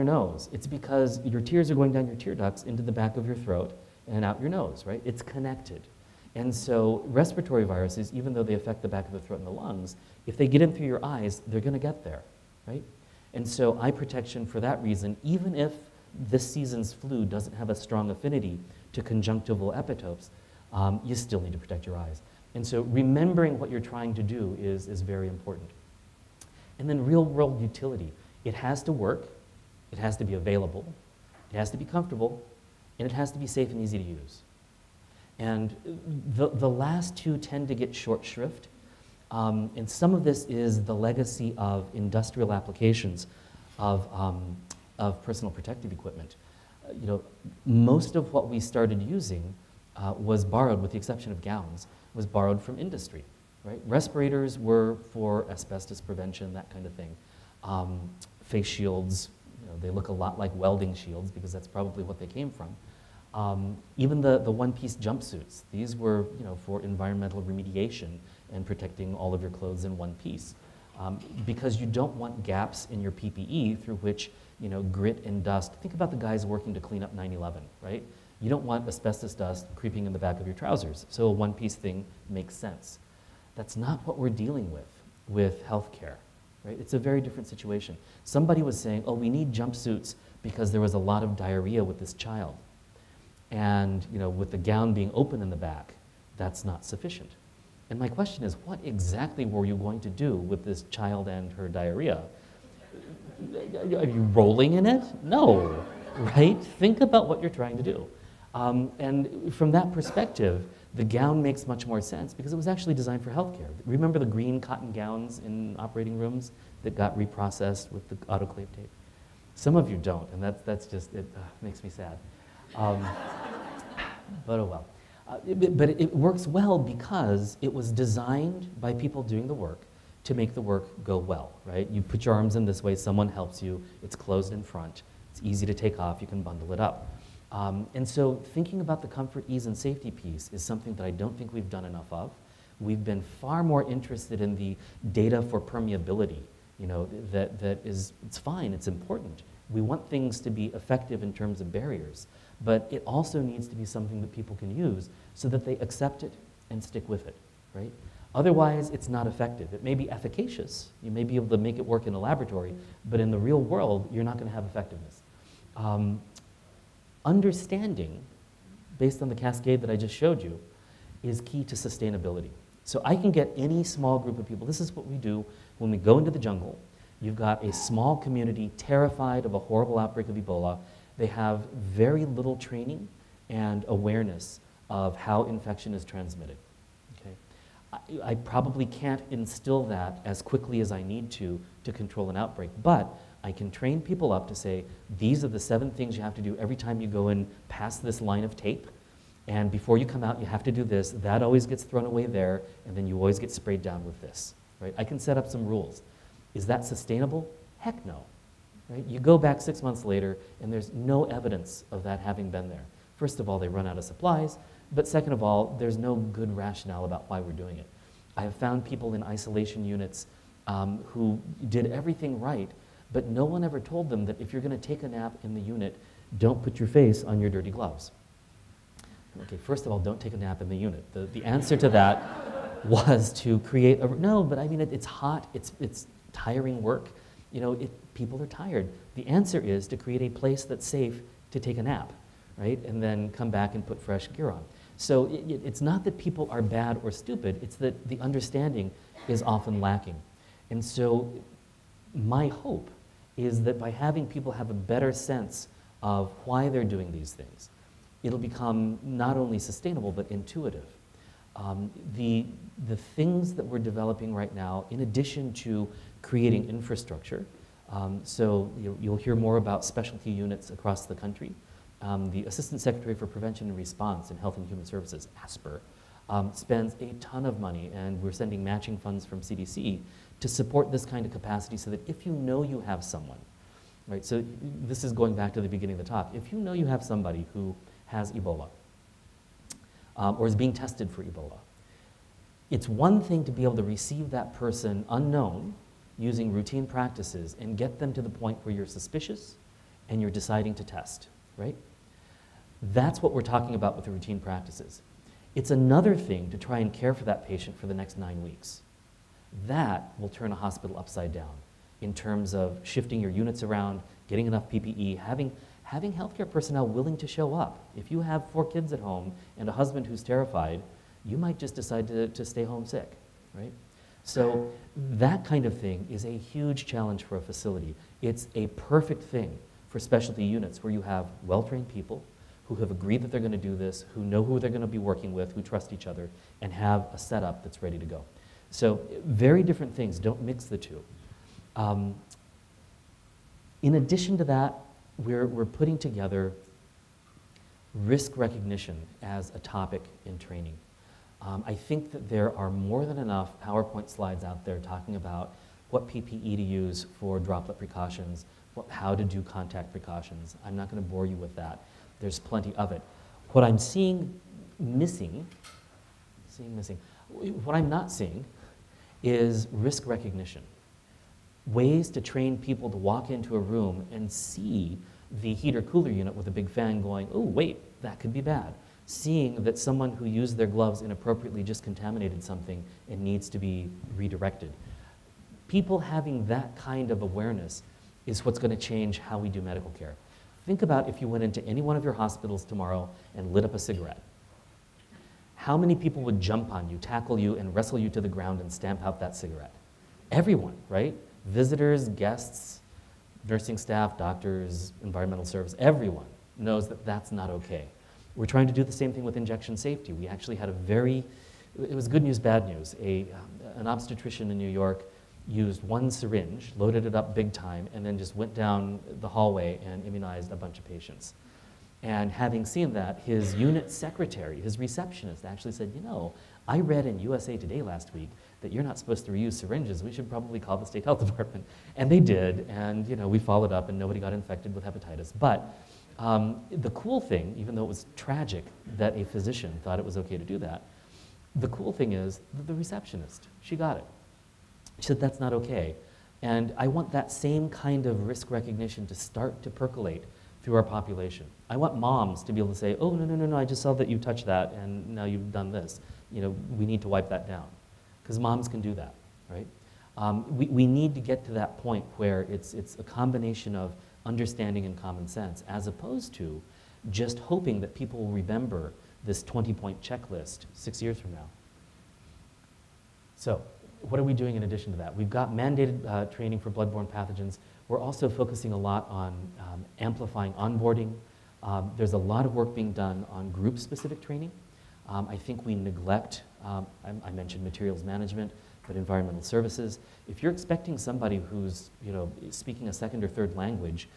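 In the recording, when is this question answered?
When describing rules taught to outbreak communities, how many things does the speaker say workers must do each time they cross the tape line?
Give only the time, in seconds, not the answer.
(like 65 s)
195 s.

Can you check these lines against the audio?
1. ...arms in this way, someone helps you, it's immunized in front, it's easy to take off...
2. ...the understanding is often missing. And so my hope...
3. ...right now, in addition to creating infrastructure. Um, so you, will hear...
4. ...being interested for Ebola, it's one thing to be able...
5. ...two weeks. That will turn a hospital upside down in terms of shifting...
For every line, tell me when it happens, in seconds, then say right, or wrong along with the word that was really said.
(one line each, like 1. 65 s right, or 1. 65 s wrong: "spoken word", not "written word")
1. 132 s wrong: "closed", not "immunized"
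2. 248 s wrong: "lacking", not "missing"
3. 264 s right
4. 290 s wrong: "tested", not "interested"
5. 308 s wrong: "nine", not "two".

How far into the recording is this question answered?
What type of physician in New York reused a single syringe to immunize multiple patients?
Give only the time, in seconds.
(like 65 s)
413 s.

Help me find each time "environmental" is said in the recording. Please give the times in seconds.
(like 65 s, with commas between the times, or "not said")
66 s, 405 s, 488 s.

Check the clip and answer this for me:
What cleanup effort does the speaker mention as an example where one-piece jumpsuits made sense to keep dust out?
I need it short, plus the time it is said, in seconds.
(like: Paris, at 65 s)
9-11, at 77 s.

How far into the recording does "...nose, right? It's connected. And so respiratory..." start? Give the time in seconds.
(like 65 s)
4 s.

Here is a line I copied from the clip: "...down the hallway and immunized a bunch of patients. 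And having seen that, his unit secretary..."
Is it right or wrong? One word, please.
right.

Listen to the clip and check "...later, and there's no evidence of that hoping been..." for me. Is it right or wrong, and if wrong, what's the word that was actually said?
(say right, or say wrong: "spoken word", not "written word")
wrong: "having", not "hoping".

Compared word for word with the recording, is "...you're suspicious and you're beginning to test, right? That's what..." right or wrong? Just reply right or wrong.
wrong.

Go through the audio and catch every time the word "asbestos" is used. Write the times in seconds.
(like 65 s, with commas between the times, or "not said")
55 s, 78 s.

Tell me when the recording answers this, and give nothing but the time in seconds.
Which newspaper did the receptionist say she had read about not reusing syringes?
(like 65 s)
427 s.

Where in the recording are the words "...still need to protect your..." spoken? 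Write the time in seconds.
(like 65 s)
21 s.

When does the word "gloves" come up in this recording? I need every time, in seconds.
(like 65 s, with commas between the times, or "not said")
227 s, 380 s.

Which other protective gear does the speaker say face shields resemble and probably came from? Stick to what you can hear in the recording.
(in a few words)
Welding shields.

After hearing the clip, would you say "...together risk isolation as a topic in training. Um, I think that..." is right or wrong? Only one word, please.
wrong.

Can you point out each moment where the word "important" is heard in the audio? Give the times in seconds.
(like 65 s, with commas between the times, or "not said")
25 s, 148 s.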